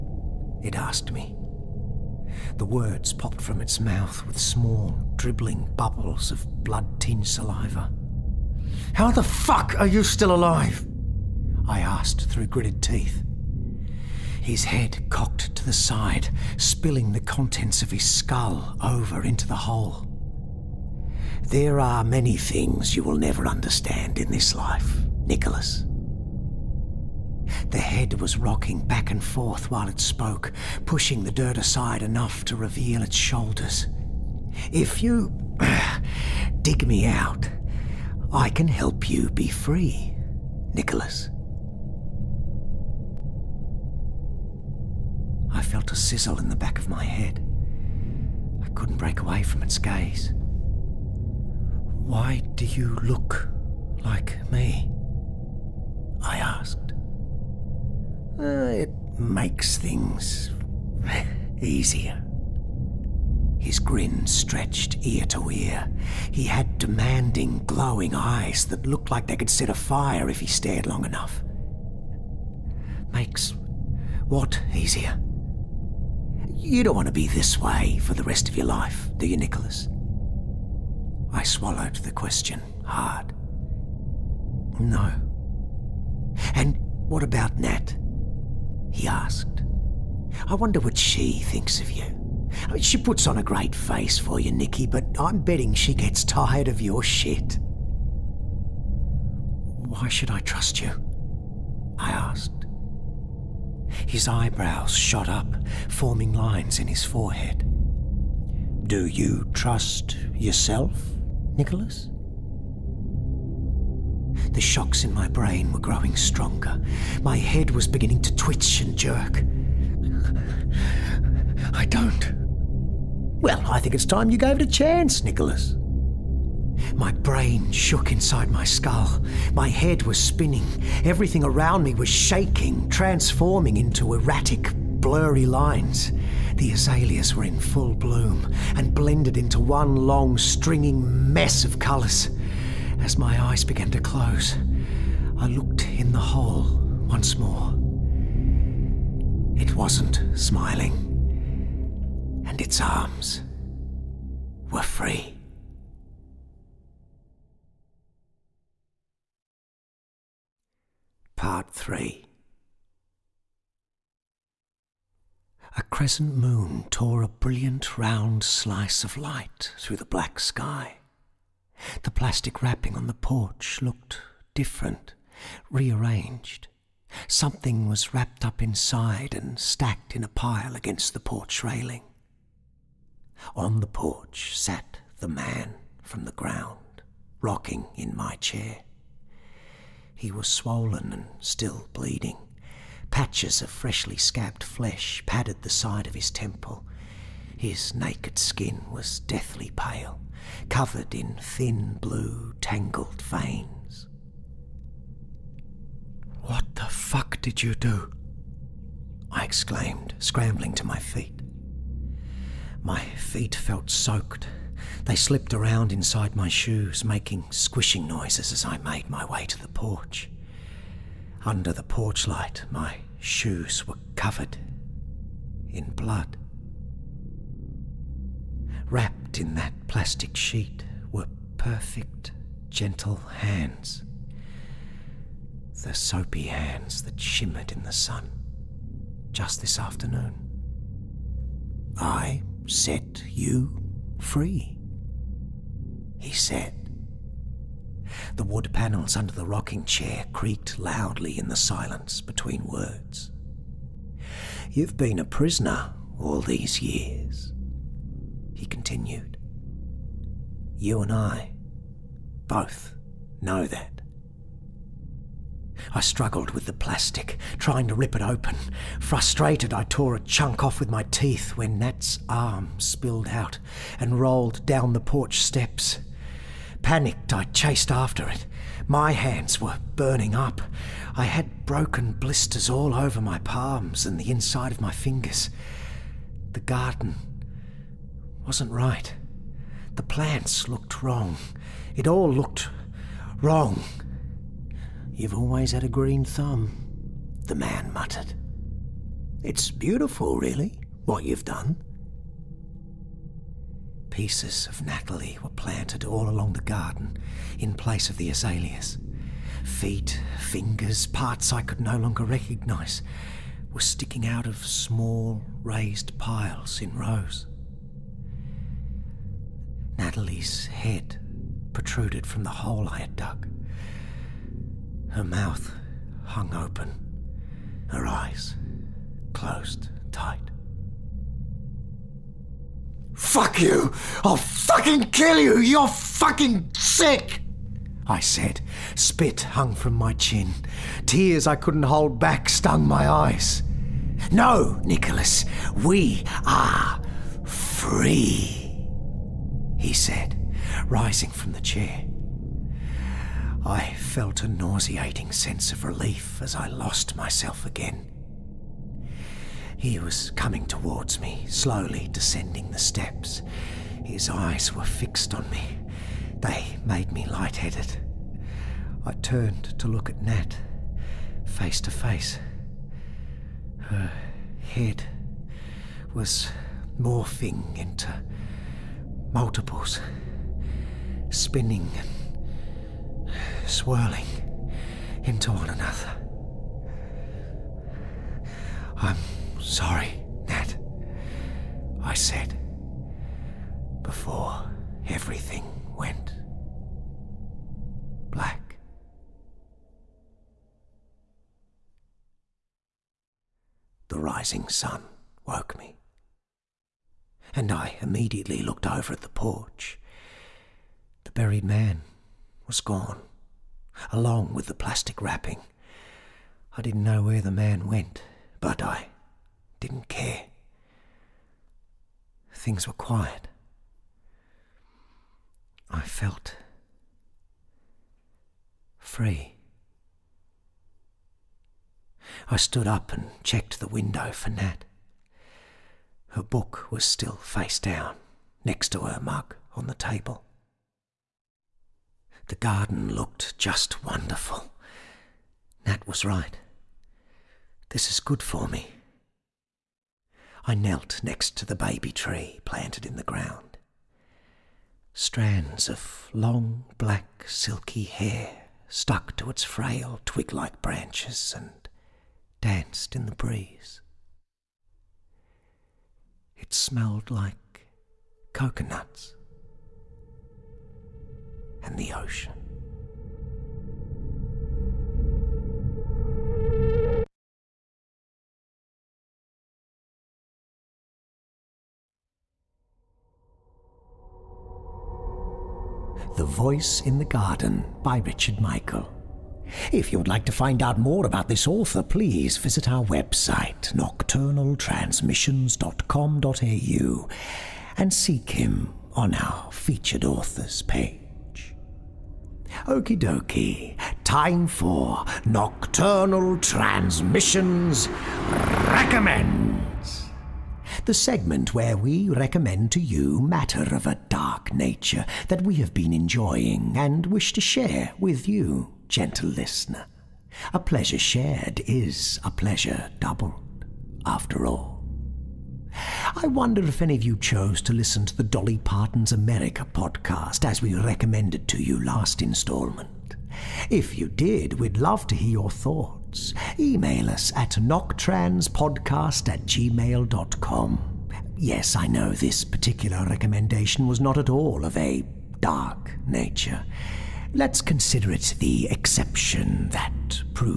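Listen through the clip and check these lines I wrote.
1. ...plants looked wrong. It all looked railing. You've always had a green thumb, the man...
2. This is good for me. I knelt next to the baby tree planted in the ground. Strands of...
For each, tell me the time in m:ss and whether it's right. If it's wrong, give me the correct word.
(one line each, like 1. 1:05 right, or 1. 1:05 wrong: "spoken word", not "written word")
1. 4:50 wrong: "wrong", not "railing"
2. 7:27 right.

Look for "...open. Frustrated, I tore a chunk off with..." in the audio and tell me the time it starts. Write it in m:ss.
4:28.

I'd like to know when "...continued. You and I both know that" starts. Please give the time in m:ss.
4:18.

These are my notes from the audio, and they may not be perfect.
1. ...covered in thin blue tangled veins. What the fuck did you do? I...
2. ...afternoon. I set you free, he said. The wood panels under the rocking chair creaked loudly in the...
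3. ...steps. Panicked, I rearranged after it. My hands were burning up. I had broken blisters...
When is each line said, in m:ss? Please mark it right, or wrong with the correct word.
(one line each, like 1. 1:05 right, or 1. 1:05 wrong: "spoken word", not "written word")
1. 3:20 right
2. 3:59 right
3. 4:35 wrong: "chased", not "rearranged".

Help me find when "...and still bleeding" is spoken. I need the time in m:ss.
3:11.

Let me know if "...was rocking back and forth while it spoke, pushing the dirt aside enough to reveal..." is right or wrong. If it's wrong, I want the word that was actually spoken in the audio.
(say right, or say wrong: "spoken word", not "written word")
right.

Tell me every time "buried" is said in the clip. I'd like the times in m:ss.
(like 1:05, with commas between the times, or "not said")
6:51.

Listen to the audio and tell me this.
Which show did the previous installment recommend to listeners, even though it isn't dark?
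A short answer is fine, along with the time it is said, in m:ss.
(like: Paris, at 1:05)
Dolly Parton's America, at 8:48.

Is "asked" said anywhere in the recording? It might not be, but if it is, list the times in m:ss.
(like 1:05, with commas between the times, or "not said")
0:00, 0:11, 0:56, 1:29, 1:42.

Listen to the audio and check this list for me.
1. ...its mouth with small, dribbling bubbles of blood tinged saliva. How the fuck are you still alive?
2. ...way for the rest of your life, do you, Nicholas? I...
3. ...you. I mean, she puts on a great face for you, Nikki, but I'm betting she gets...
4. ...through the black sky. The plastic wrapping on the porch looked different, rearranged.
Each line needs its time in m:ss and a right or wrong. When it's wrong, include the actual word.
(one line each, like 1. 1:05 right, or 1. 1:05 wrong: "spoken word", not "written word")
1. 0:03 right
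2. 1:17 right
3. 1:31 right
4. 2:49 right.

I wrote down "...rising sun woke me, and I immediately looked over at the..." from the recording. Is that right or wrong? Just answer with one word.
right.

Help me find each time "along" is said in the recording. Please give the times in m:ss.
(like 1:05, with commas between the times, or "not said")
5:06, 6:54.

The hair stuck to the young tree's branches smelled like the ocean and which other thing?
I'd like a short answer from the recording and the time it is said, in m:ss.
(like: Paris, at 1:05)
Coconuts, at 7:48.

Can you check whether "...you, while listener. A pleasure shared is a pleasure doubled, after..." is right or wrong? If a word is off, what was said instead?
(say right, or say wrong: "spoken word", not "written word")
wrong: "gentle", not "while".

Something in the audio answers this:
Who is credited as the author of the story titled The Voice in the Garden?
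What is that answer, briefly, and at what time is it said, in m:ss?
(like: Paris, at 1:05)
Richard Michael, at 8:08.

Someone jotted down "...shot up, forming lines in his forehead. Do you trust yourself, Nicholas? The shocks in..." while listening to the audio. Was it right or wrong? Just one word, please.
right.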